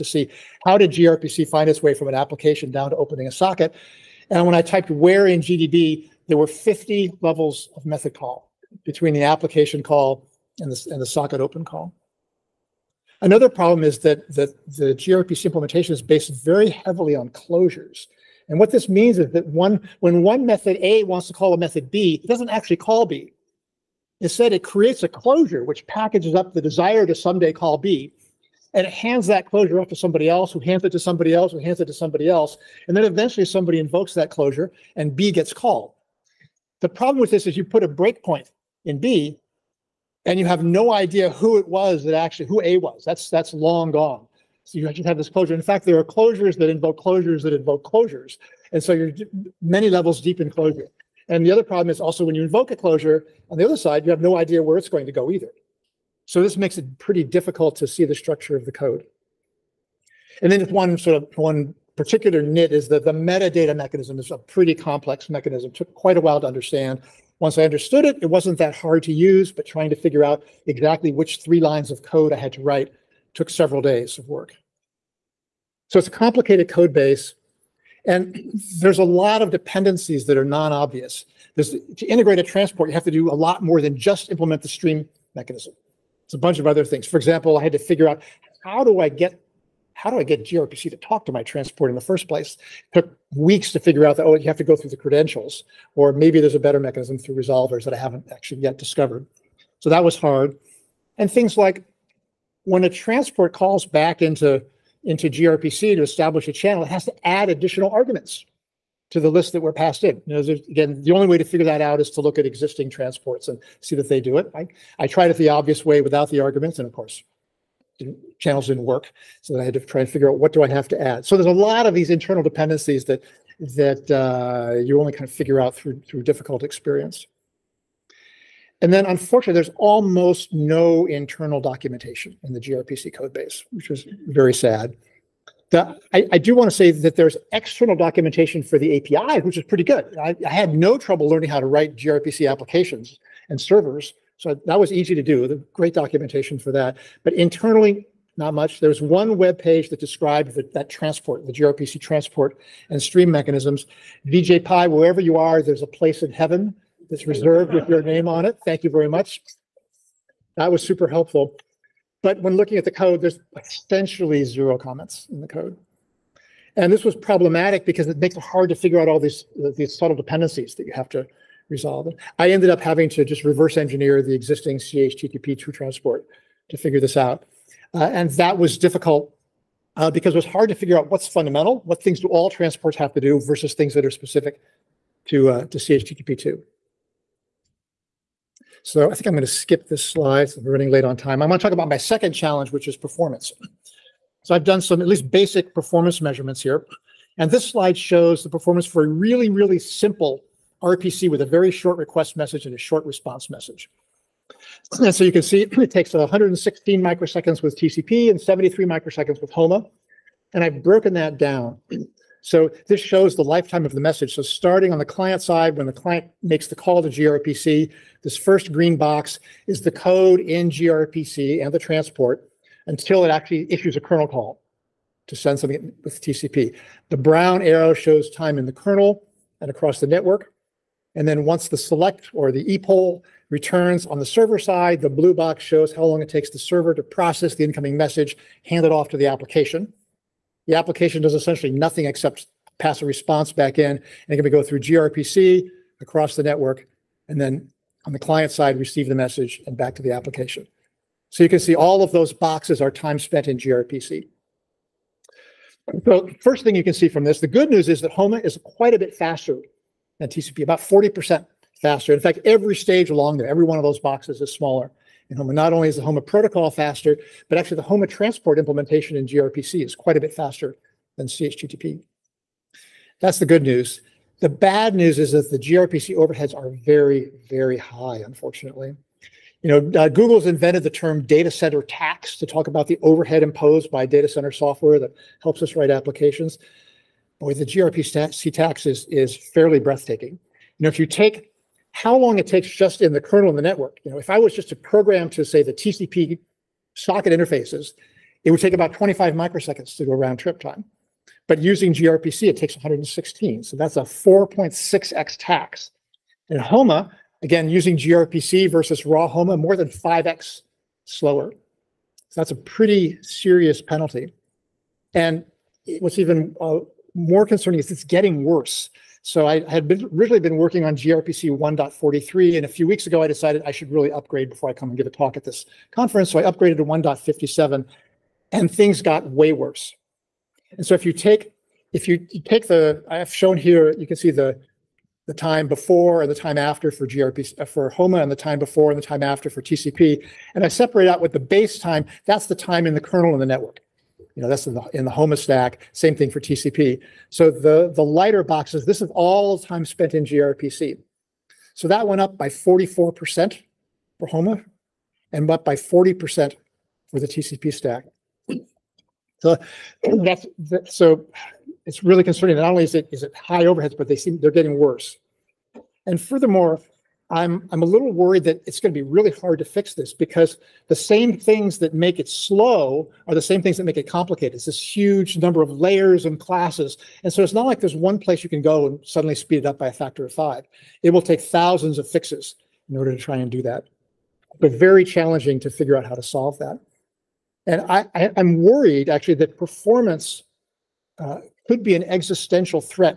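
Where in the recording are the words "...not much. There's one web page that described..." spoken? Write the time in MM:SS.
02:28.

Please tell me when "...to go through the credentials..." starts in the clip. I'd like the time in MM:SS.
01:34.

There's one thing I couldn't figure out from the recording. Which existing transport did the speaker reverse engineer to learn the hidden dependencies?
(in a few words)
CHTTP2.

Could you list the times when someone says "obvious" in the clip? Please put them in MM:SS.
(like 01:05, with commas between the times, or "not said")
01:20, 01:55.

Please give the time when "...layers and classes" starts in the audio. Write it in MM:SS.
06:15.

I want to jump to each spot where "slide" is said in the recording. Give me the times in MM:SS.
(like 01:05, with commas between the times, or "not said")
03:10, 03:17.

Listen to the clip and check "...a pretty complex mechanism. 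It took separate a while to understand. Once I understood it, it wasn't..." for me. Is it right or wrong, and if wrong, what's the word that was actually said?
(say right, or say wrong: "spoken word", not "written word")
wrong: "quite", not "separate".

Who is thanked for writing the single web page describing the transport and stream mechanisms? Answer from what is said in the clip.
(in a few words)
Vijay Pai.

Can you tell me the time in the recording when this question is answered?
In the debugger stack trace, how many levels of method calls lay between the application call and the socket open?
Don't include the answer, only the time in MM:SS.
00:06.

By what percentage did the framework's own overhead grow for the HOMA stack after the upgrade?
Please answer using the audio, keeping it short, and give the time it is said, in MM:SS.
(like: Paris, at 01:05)
44%, at 05:52.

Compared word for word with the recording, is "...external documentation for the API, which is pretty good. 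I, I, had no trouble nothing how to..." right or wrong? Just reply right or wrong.
wrong.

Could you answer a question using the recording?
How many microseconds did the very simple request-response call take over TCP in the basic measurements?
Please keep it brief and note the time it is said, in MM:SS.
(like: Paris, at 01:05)
116 microseconds, at 03:26.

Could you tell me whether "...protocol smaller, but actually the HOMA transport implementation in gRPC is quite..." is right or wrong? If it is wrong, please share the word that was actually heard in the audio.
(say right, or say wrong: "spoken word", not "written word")
wrong: "faster", not "smaller".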